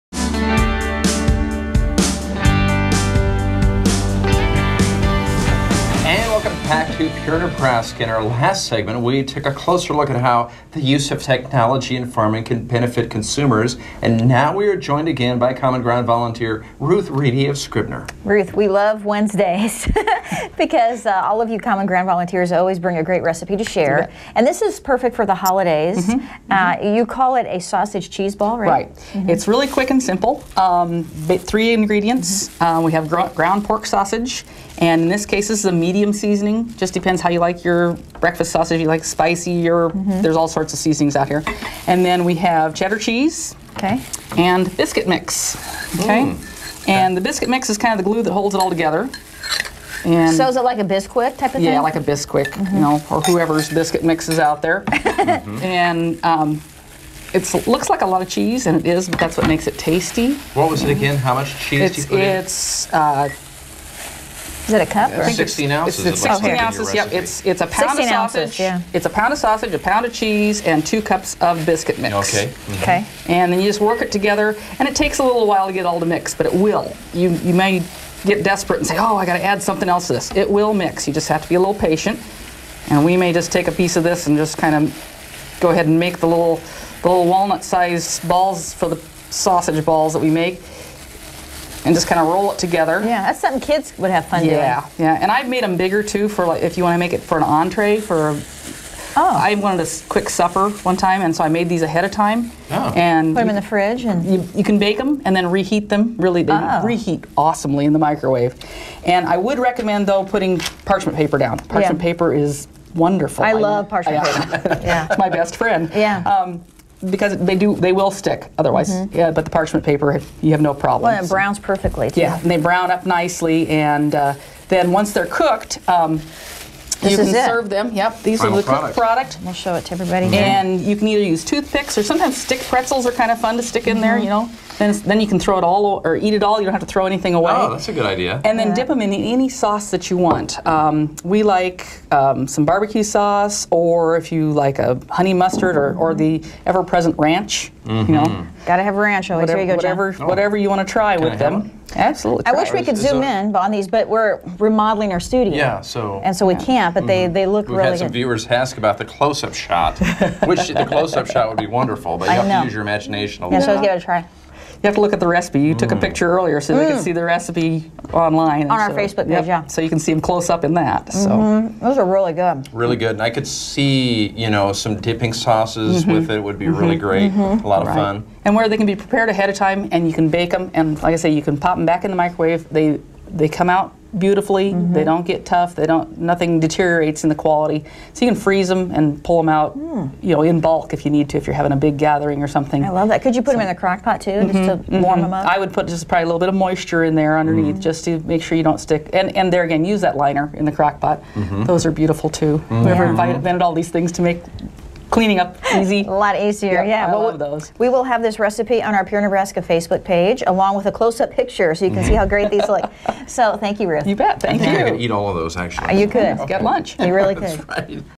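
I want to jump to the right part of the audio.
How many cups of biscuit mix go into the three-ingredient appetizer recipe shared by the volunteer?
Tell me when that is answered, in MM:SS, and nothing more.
01:10.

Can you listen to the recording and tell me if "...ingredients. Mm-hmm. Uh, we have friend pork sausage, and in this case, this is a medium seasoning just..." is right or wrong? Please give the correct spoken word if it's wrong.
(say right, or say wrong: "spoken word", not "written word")
wrong: "ground", not "friend".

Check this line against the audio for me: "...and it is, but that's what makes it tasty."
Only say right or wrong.
right.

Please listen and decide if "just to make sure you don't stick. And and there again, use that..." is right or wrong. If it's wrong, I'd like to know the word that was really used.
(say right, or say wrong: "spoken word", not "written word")
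right.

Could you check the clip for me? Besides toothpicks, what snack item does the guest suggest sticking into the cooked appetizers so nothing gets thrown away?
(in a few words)
stick pretzels.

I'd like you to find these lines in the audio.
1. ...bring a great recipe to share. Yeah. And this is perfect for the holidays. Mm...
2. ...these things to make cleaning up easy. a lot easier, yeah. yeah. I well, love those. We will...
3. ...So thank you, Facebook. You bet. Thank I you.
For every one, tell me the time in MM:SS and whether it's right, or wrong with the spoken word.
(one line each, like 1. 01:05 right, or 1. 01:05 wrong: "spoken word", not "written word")
1. 00:22 right
2. 03:23 right
3. 03:33 wrong: "Ruth", not "Facebook".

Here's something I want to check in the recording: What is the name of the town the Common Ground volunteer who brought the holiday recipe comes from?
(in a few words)
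Scribner.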